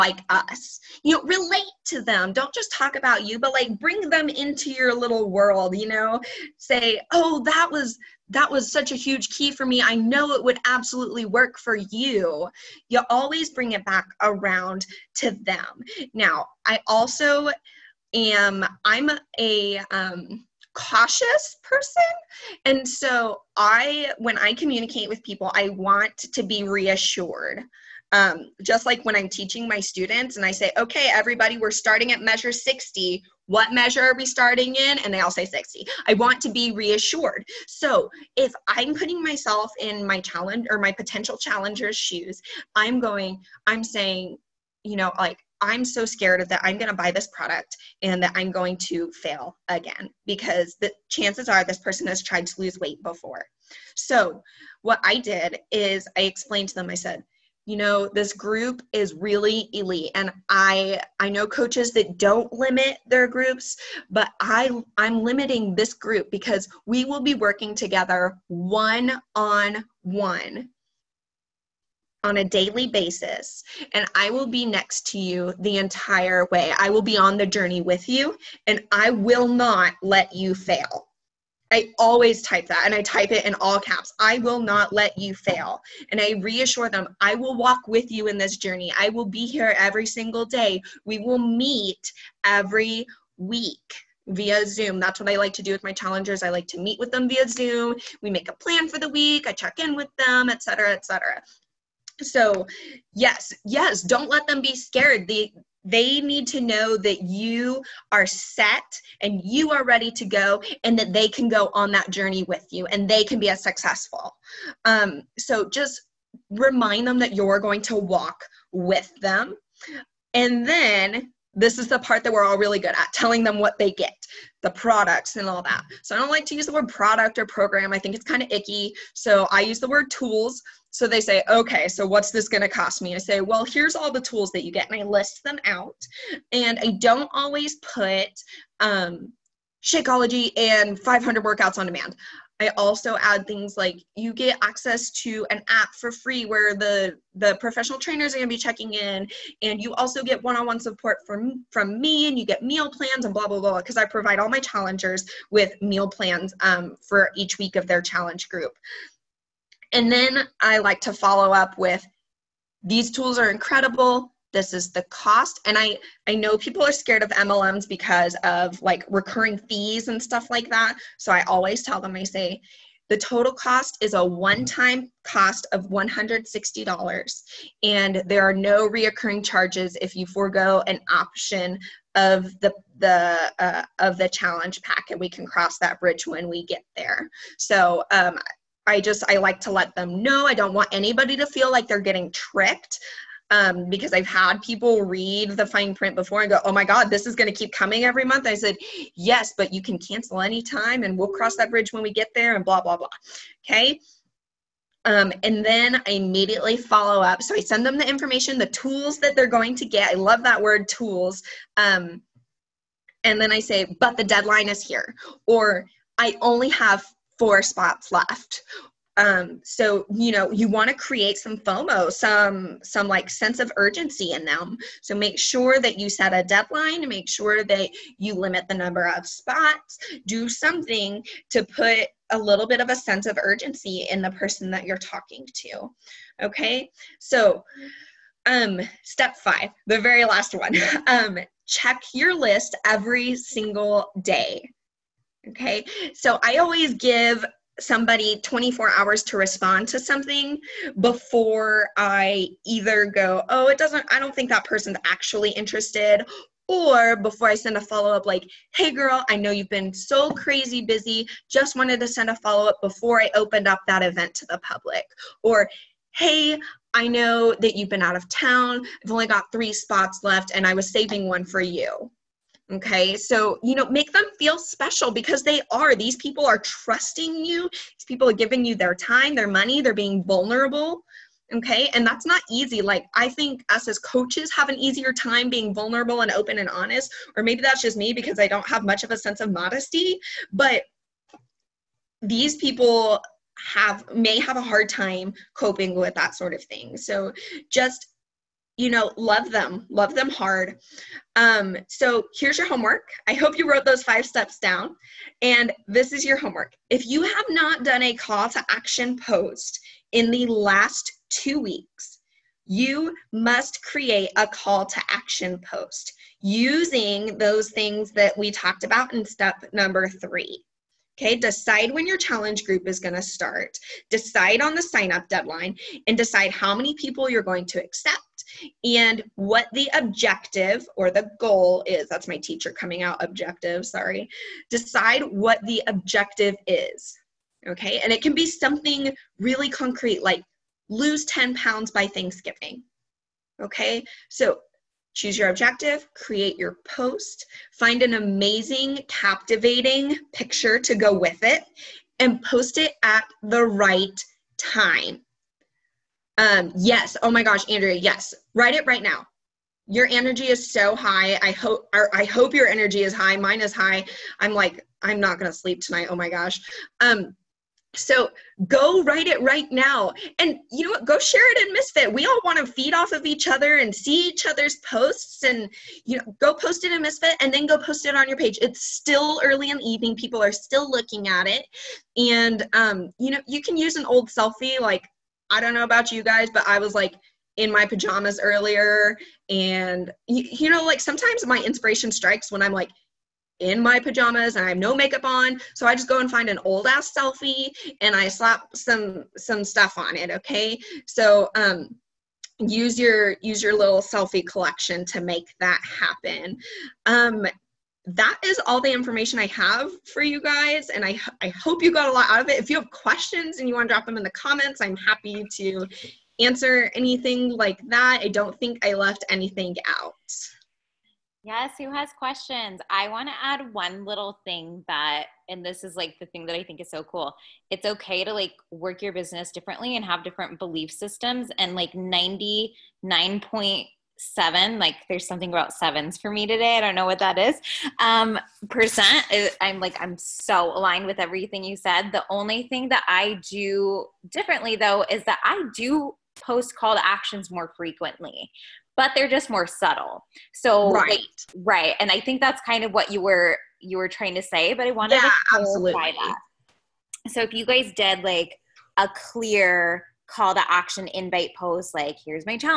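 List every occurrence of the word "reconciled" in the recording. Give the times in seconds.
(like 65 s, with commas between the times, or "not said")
not said.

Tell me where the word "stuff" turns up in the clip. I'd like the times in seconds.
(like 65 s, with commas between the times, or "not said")
170 s, 399 s.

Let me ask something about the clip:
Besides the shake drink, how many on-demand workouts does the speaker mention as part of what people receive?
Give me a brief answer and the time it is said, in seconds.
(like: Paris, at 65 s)
500, at 140 s.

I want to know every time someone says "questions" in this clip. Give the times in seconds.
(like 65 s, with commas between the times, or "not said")
412 s, 422 s.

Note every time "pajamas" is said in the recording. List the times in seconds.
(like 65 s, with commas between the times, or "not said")
387 s, 393 s.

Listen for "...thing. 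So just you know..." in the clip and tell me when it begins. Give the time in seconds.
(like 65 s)
296 s.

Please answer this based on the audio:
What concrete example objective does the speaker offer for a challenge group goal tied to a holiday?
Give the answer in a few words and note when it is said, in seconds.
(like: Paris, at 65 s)
Lose 10 pounds by Thanksgiving, at 340 s.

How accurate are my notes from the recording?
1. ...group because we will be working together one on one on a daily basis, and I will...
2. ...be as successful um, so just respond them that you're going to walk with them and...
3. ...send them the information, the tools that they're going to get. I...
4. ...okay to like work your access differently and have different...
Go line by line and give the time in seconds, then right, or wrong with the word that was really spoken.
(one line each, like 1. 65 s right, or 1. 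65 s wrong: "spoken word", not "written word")
1. 65 s right
2. 113 s wrong: "remind", not "respond"
3. 207 s right
4. 427 s wrong: "business", not "access".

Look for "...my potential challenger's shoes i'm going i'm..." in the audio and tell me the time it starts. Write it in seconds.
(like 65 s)
40 s.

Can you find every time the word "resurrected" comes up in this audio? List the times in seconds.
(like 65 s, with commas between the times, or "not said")
not said.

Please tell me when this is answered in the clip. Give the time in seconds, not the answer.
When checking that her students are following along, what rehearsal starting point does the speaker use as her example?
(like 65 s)
32 s.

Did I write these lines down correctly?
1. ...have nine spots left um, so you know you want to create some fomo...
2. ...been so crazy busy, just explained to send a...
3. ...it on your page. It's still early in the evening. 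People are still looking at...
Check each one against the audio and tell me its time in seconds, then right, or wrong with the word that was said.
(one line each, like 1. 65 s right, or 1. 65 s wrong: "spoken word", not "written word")
1. 216 s wrong: "four", not "nine"
2. 259 s wrong: "wanted", not "explained"
3. 378 s right.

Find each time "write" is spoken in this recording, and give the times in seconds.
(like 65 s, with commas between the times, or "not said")
358 s, 369 s.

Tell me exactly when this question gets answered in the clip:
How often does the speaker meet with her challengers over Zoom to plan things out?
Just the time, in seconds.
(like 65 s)
92 s.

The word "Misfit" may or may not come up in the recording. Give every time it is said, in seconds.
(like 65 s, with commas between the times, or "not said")
371 s, 377 s.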